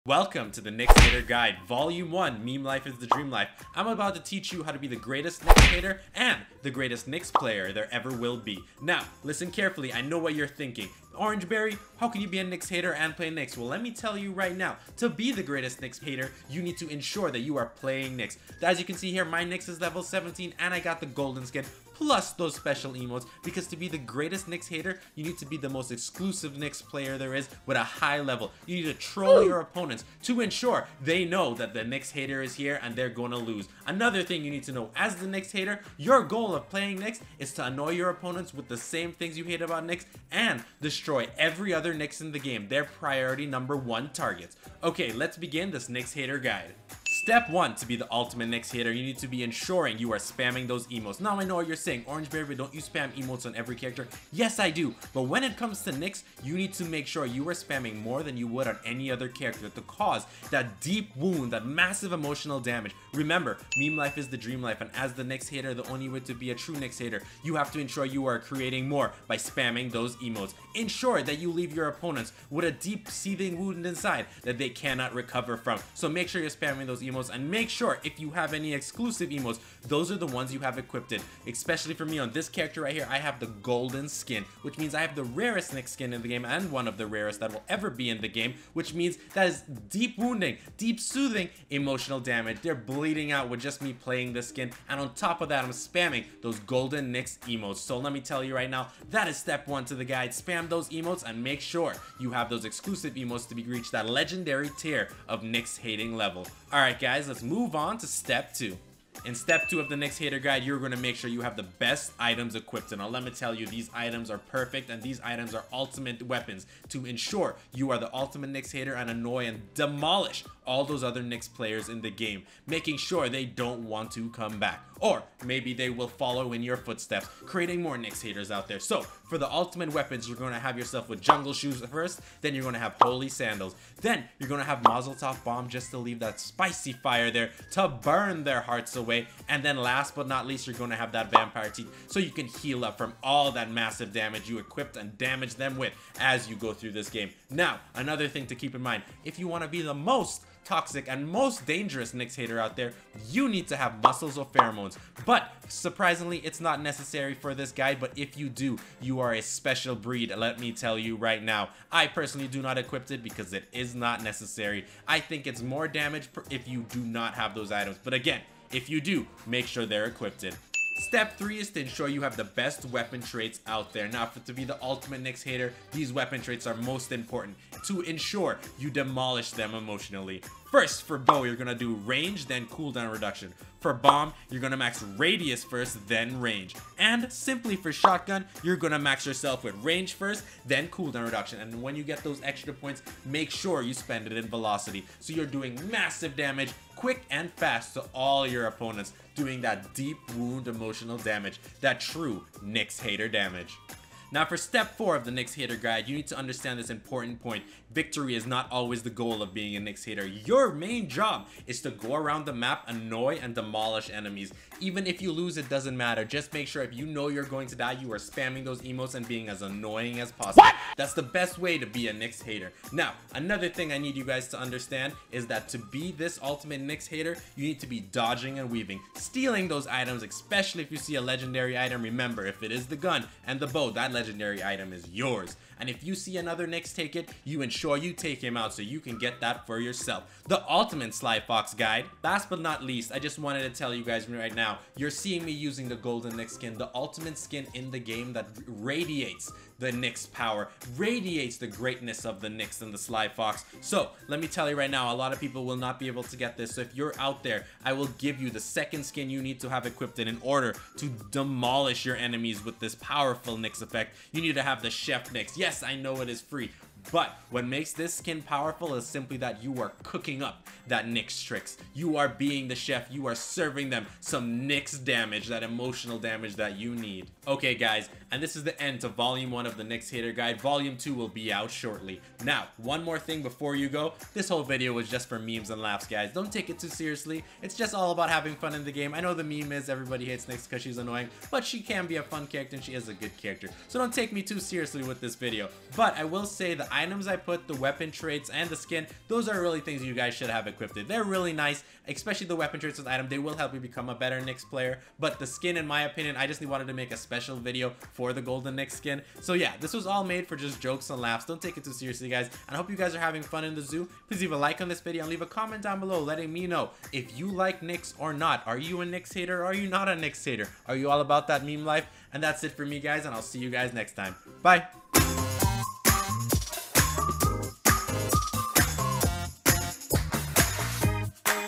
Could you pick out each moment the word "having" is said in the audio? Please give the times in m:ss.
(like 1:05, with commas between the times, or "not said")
4:48, 5:13.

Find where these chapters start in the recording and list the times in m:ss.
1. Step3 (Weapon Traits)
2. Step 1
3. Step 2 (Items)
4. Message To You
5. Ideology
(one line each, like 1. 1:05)
1. 2:49
2. 0:46
3. 1:48
4. 4:00
5. 3:22.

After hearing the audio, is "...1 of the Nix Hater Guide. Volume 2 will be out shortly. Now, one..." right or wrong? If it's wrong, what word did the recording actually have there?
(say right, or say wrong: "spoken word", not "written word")
right.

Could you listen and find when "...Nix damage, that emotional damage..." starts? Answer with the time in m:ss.
4:34.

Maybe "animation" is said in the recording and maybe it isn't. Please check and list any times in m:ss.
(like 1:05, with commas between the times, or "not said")
not said.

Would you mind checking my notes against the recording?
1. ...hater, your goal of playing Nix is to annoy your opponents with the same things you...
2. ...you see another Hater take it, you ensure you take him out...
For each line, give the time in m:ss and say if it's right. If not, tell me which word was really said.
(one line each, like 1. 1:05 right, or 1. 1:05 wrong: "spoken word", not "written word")
1. 0:35 right
2. 3:56 wrong: "Nix", not "Hater".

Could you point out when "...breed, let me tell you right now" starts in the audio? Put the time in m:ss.
2:39.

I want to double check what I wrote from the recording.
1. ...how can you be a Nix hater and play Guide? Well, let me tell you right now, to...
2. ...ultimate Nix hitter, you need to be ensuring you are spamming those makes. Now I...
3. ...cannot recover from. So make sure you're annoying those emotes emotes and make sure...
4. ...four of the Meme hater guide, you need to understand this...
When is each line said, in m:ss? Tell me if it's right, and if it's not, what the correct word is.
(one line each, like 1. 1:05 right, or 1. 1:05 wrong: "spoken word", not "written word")
1. 0:11 wrong: "Nix", not "Guide"
2. 0:48 wrong: "emotes", not "makes"
3. 1:14 wrong: "spamming", not "annoying"
4. 3:24 wrong: "Nix", not "Meme".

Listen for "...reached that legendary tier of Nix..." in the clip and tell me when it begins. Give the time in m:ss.
1:43.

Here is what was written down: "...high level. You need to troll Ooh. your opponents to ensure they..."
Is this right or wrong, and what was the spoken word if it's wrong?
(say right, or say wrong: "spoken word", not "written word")
right.